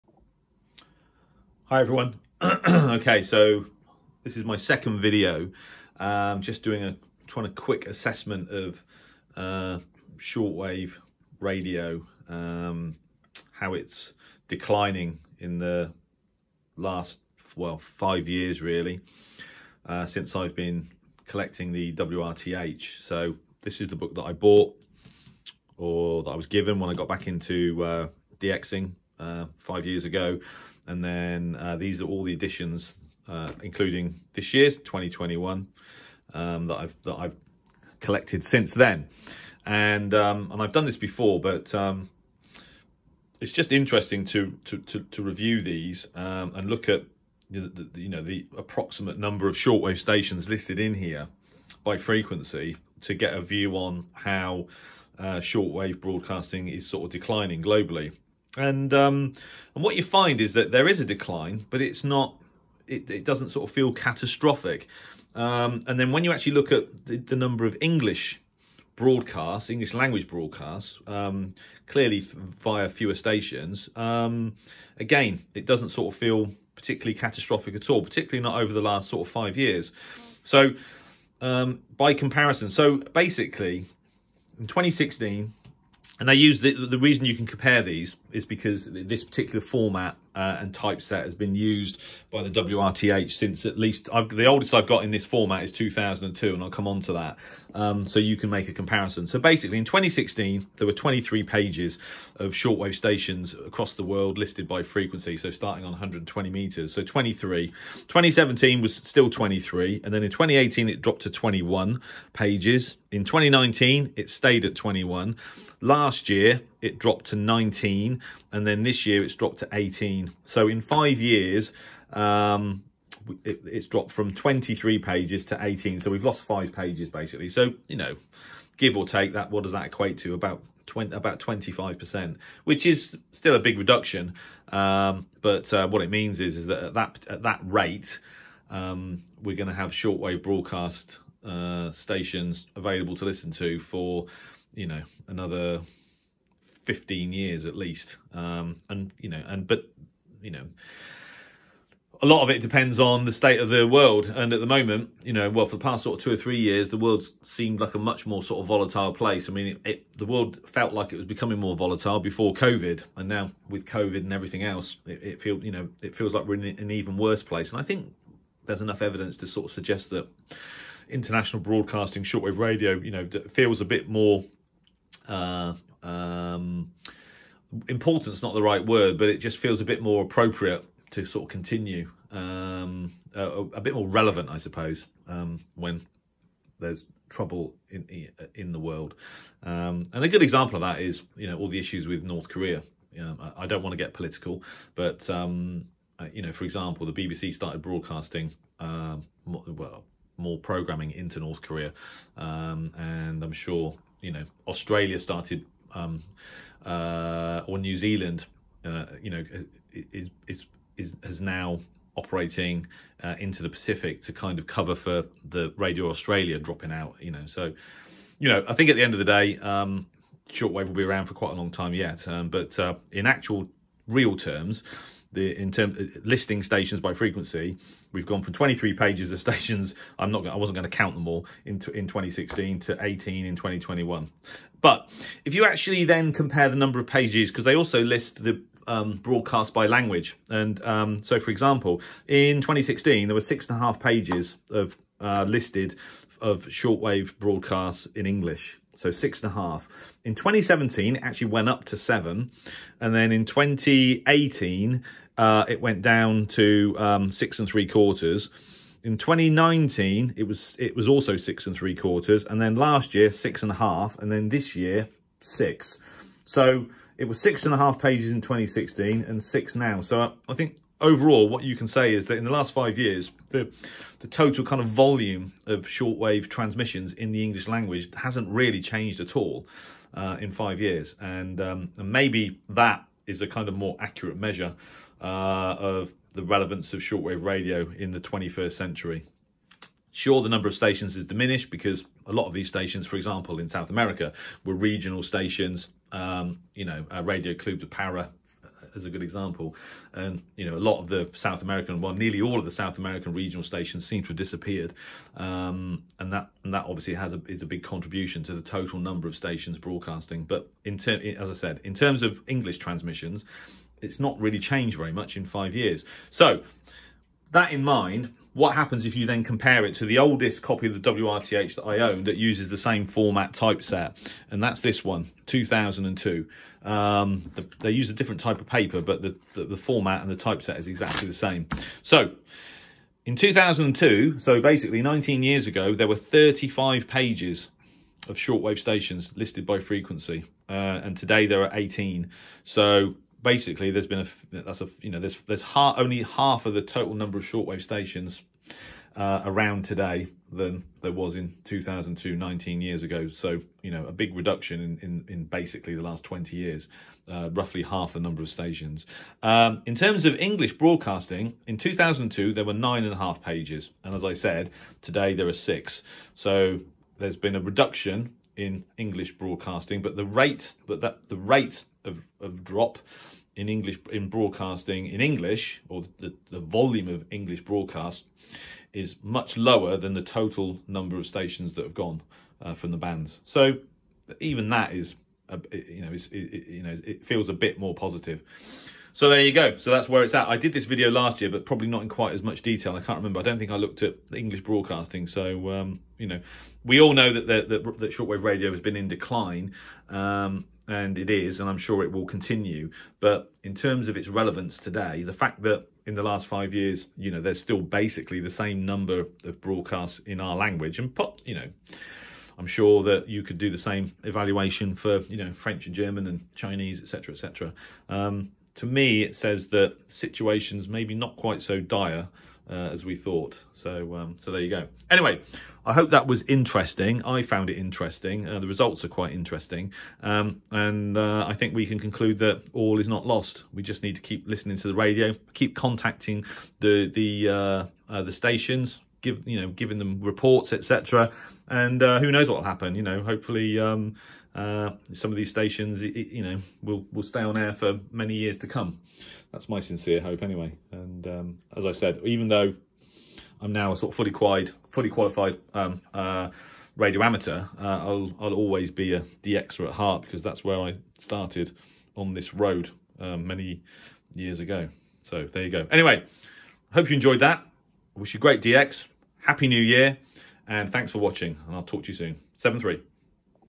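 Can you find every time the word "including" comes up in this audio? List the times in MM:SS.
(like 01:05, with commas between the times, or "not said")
00:33.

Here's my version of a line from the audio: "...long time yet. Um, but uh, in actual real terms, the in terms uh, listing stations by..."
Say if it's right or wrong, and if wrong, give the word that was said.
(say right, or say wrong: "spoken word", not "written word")
right.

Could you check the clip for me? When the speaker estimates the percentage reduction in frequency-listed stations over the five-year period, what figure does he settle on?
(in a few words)
25 percent.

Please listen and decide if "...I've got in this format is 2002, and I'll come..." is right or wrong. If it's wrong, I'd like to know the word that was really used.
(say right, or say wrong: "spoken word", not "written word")
right.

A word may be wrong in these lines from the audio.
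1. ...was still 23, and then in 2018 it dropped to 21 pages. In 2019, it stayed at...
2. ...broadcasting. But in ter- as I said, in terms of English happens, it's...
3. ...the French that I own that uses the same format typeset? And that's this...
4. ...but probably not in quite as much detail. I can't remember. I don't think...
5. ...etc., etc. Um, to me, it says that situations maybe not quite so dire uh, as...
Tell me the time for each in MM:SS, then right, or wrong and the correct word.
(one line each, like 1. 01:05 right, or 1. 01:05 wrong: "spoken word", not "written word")
1. 01:48 right
2. 05:09 wrong: "transmissions", not "happens"
3. 05:21 wrong: "WRTH", not "French"
4. 06:31 right
5. 06:57 right.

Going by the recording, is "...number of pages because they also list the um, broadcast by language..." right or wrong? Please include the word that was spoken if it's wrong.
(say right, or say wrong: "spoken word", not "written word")
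right.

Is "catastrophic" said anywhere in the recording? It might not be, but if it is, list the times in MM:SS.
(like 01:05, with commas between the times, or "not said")
01:03, 01:17.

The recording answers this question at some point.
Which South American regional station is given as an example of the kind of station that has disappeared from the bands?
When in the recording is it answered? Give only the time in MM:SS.
04:57.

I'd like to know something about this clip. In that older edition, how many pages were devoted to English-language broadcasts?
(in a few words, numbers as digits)
9.5.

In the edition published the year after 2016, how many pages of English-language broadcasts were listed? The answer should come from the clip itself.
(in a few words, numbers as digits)
7.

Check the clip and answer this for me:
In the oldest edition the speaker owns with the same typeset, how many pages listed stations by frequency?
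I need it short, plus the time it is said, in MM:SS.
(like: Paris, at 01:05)
35, at 05:36.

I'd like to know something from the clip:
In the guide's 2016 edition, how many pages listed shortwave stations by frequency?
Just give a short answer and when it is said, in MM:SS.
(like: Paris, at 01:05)
23, at 01:40.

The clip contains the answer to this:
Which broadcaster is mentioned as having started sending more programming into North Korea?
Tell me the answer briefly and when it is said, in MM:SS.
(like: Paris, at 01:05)
BBC, at 03:17.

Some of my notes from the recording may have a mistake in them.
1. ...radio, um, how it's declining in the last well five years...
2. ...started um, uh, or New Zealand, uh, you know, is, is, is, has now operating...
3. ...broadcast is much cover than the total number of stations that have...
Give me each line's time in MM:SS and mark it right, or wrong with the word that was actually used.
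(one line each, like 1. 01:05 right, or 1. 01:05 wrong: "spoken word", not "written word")
1. 00:11 right
2. 03:25 right
3. 06:17 wrong: "lower", not "cover".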